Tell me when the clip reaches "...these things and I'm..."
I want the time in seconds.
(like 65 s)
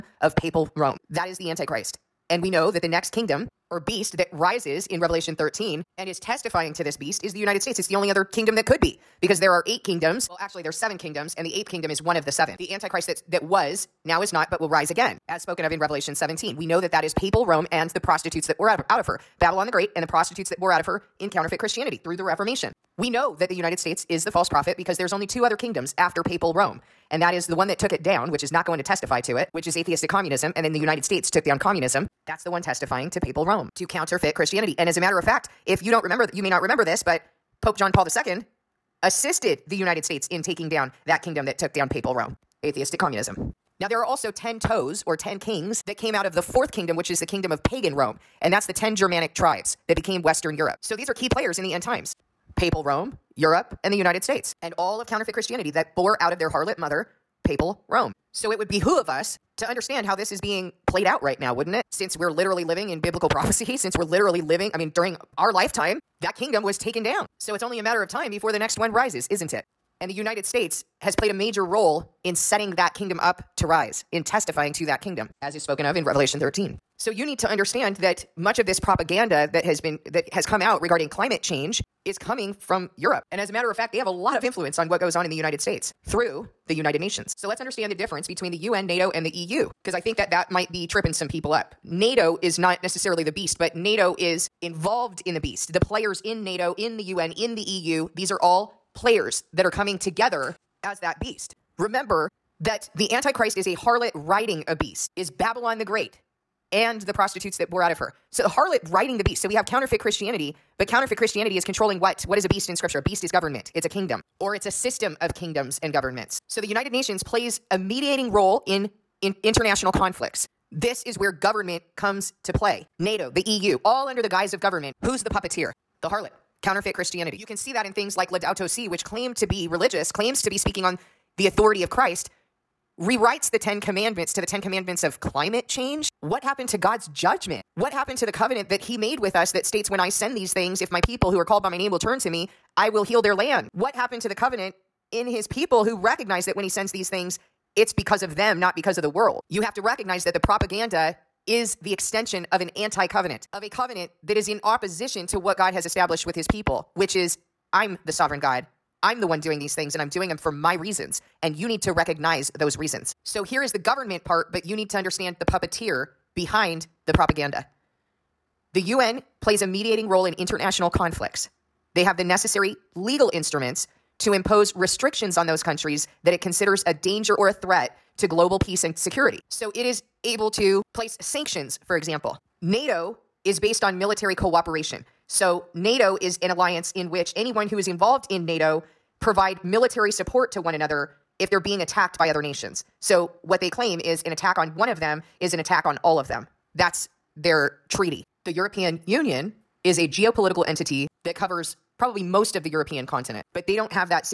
159 s.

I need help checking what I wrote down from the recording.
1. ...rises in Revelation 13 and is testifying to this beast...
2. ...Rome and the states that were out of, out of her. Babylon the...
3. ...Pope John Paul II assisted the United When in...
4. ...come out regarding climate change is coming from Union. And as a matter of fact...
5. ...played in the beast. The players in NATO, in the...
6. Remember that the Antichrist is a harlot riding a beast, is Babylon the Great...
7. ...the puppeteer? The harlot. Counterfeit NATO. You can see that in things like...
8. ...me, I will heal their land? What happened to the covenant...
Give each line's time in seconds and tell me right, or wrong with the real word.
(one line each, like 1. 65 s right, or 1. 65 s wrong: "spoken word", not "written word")
1. 4 s right
2. 17 s wrong: "prostitutes", not "states"
3. 37 s wrong: "States", not "When"
4. 80 s wrong: "Europe", not "Union"
5. 94 s wrong: "involved", not "played"
6. 101 s right
7. 125 s wrong: "Christianity", not "NATO"
8. 142 s right.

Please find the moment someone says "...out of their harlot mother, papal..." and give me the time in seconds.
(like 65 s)
56 s.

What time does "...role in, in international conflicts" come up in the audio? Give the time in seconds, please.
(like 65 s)
118 s.